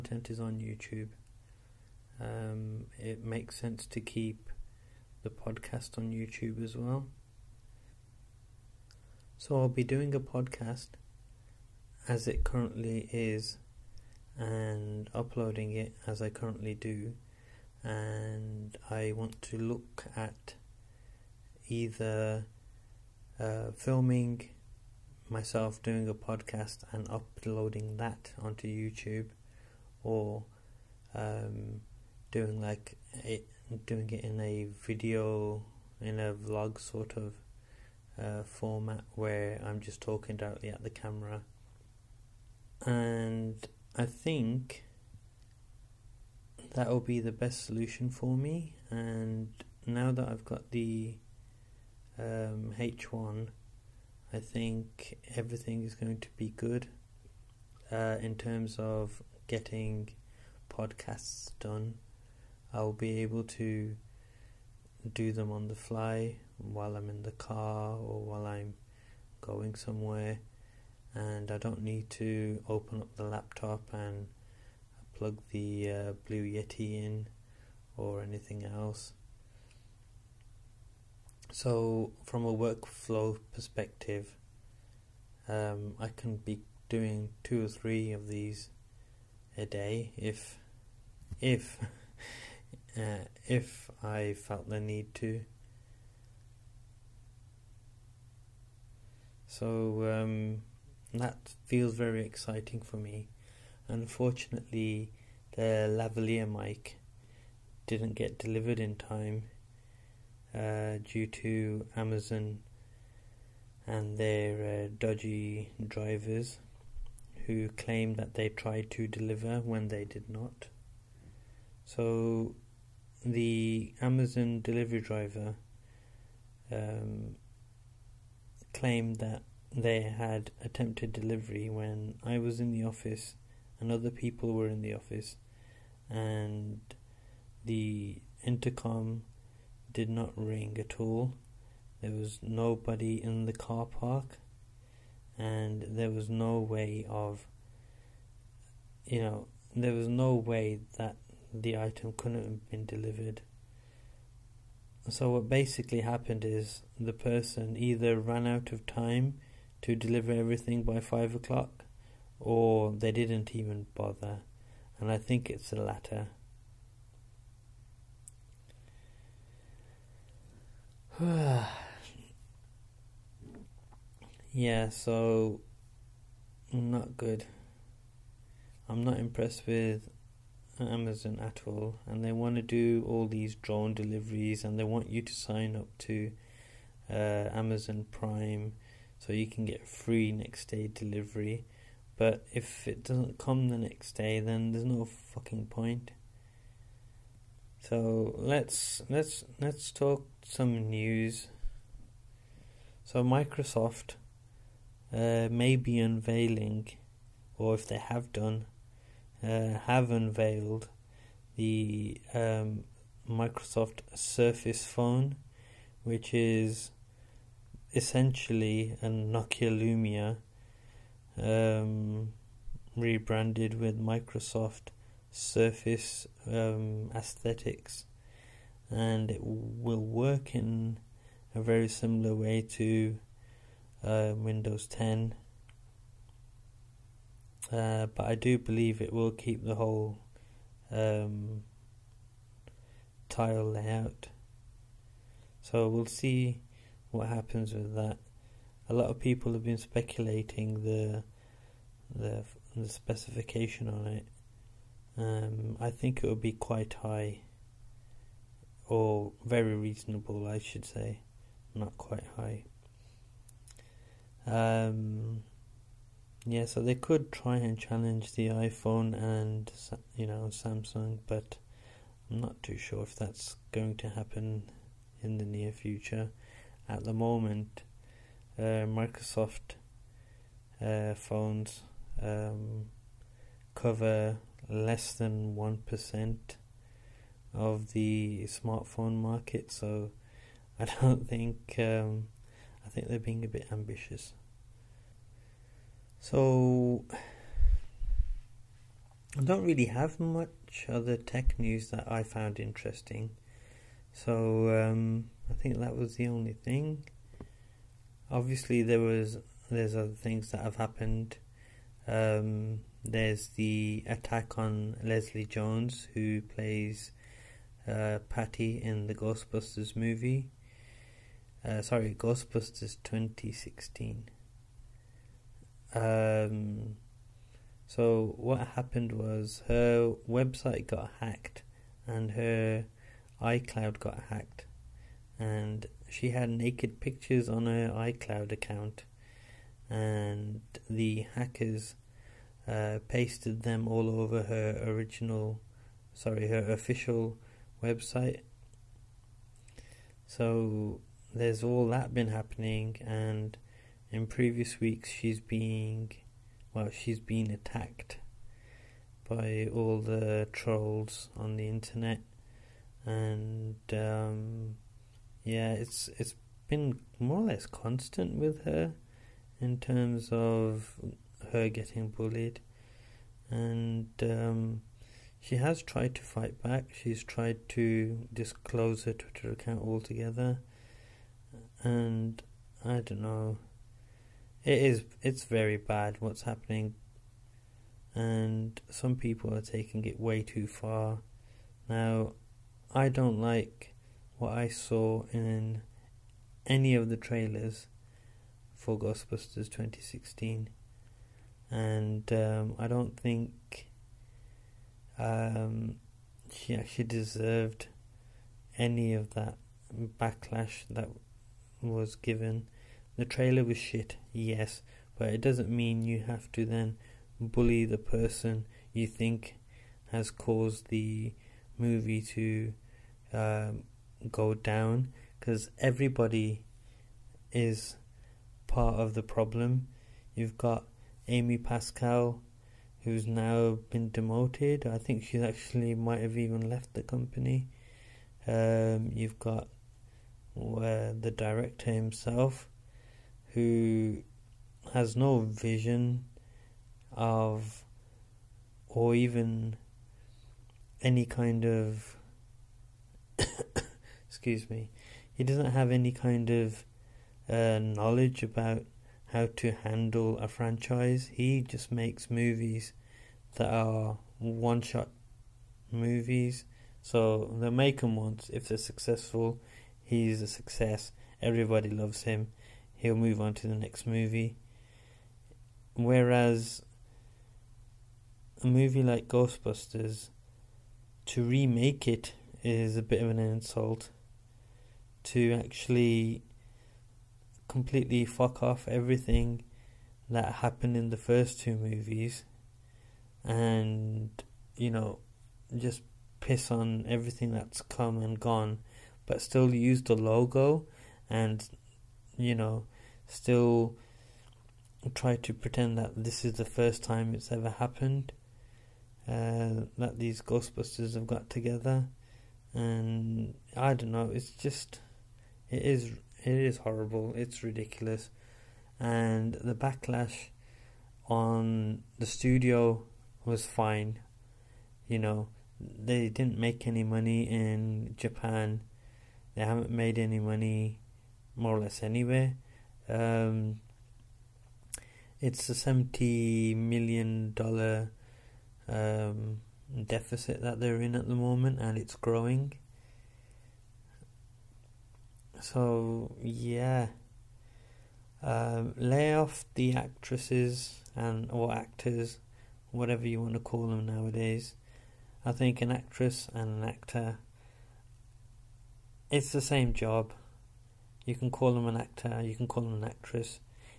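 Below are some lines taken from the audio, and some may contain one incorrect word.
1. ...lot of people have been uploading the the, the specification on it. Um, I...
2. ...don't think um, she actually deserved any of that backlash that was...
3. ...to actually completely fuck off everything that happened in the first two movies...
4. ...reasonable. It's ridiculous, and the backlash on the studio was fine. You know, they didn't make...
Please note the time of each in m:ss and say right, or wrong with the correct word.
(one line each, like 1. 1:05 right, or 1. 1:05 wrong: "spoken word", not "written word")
1. 4:08 wrong: "speculating", not "uploading"
2. 6:42 right
3. 8:05 right
4. 8:36 wrong: "horrible", not "reasonable".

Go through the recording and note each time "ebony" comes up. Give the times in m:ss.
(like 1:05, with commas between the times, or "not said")
not said.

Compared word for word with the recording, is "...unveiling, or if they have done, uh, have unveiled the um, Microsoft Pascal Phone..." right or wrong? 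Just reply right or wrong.
wrong.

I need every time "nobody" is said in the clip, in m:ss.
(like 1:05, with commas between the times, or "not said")
2:22.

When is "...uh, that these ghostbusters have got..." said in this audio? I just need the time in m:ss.
8:29.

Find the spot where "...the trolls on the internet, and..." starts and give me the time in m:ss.
6:00.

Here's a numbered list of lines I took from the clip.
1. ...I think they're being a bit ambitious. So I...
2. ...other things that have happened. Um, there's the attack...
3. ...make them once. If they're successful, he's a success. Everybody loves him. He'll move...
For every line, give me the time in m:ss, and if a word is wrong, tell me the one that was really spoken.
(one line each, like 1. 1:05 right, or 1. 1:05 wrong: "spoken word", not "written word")
1. 4:52 right
2. 5:09 right
3. 7:47 right.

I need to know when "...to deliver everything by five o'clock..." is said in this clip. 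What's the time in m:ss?
2:39.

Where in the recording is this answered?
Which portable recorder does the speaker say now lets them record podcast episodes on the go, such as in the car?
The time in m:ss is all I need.
0:52.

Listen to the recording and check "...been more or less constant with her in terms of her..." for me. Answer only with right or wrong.
right.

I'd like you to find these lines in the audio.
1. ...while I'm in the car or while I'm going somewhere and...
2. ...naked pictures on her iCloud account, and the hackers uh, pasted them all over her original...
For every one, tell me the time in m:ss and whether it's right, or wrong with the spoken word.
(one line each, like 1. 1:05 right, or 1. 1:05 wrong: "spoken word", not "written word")
1. 1:06 right
2. 5:36 right.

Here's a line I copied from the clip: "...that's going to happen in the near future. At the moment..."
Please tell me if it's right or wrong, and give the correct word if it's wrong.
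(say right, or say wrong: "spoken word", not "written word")
right.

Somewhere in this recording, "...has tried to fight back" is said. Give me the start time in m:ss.
6:15.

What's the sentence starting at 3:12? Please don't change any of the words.
But if it doesn't come the next day, then there's no fucking point.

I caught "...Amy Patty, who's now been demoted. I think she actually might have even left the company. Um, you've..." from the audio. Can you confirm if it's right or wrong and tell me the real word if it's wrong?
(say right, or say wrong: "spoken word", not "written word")
wrong: "Pascal", not "Patty".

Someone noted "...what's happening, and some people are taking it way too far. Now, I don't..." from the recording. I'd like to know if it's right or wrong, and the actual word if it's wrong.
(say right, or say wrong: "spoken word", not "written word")
right.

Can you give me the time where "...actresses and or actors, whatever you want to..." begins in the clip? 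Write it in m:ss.
9:09.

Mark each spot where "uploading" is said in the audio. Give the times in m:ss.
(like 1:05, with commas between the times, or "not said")
0:15, 0:27.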